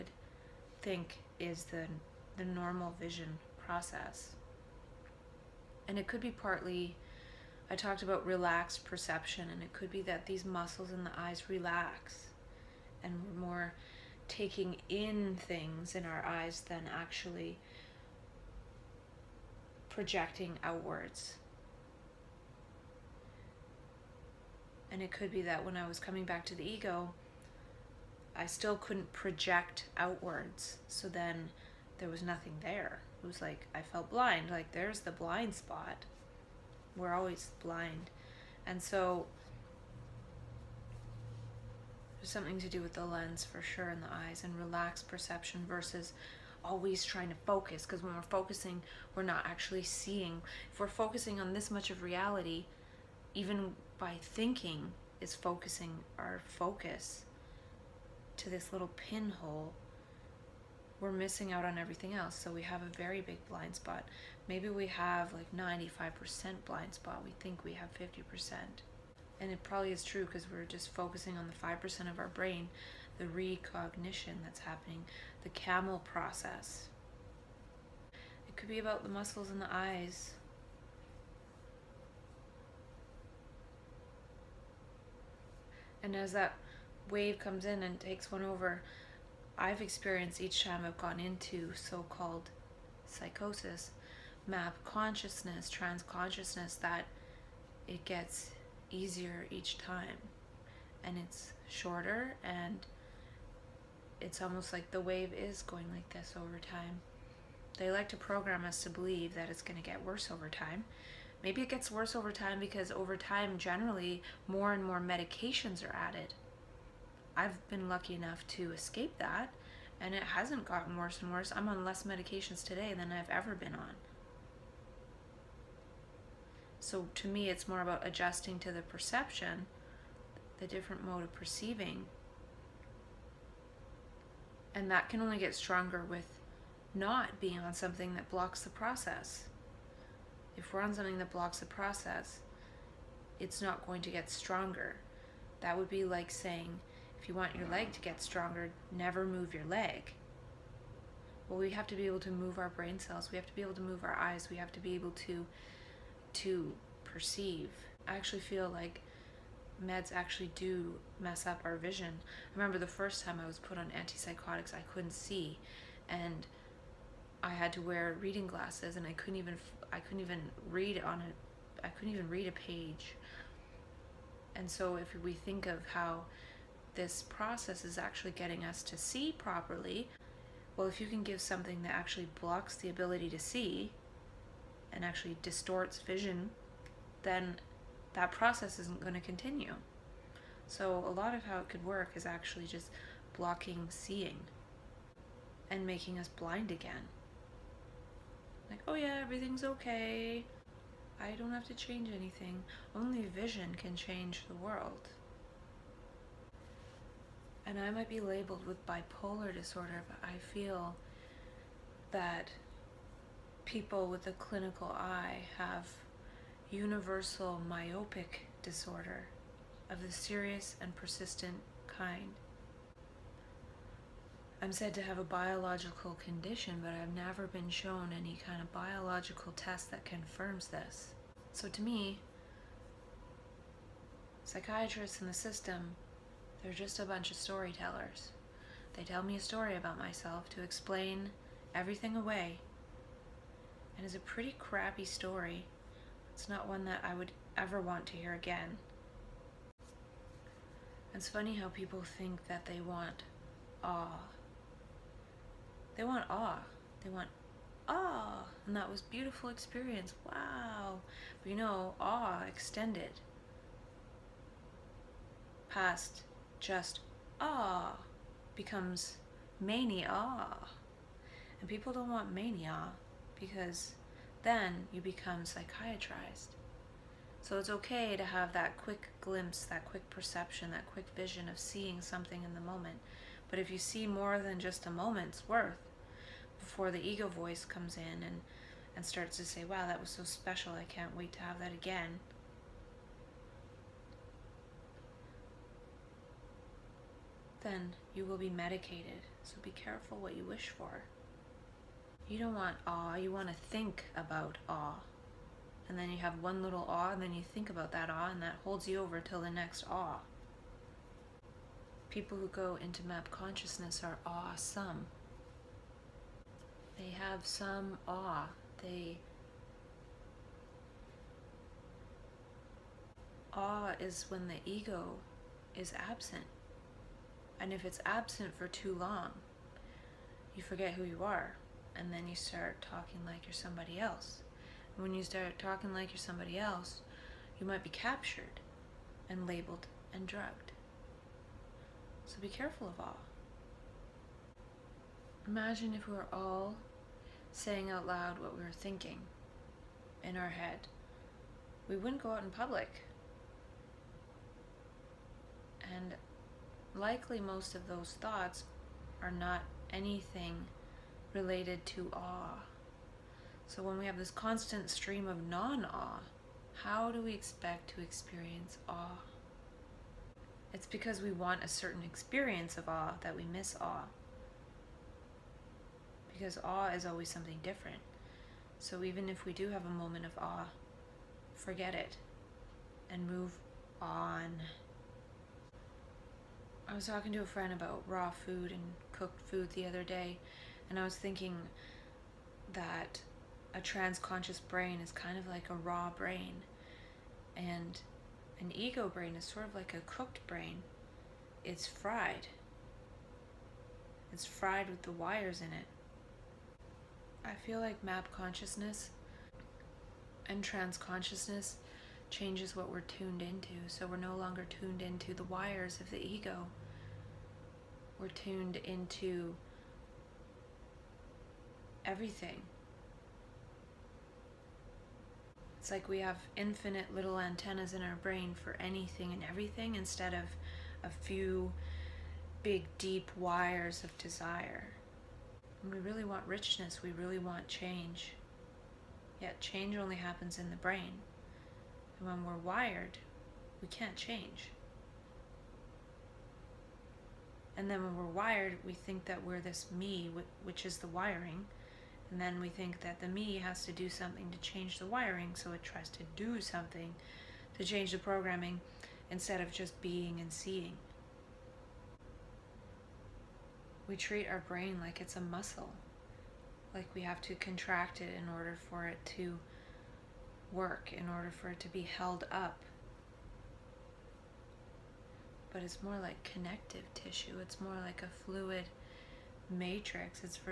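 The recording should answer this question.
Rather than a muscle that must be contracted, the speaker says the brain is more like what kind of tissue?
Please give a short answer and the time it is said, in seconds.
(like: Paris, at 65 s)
connective tissue, at 476 s.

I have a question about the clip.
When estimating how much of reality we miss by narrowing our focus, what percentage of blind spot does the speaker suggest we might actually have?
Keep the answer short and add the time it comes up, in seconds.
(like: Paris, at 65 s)
95%, at 65 s.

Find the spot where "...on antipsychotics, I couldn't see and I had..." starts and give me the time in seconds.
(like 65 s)
163 s.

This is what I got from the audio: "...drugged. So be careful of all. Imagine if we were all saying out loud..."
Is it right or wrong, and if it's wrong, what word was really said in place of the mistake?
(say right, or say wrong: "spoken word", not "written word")
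right.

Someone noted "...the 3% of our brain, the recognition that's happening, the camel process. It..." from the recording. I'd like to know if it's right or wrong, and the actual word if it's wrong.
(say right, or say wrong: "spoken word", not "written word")
wrong: "5", not "3".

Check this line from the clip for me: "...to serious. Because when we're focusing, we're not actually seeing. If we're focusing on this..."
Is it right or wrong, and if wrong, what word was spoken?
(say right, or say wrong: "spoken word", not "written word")
wrong: "focus", not "serious".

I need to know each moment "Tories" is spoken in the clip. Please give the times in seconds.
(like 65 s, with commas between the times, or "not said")
not said.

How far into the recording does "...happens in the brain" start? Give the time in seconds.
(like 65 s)
440 s.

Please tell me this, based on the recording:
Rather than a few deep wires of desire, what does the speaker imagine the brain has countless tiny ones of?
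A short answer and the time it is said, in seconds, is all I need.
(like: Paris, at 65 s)
antennas, at 427 s.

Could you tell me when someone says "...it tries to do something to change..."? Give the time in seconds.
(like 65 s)
455 s.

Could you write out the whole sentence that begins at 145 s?
That would be like saying, if you want your leg to get stronger, never move your leg.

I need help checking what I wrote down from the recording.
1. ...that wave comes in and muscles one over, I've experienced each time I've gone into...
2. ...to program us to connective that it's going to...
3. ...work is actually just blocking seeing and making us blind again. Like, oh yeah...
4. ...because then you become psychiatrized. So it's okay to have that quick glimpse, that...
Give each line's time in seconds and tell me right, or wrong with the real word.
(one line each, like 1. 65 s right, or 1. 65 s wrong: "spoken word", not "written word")
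1. 86 s wrong: "takes", not "muscles"
2. 108 s wrong: "believe", not "connective"
3. 191 s right
4. 273 s right.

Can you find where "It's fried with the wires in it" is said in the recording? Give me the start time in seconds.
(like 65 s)
404 s.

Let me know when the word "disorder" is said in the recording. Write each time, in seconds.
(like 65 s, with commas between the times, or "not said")
209 s, 218 s.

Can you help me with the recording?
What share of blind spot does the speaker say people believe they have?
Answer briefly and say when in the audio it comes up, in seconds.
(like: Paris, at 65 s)
50%, at 67 s.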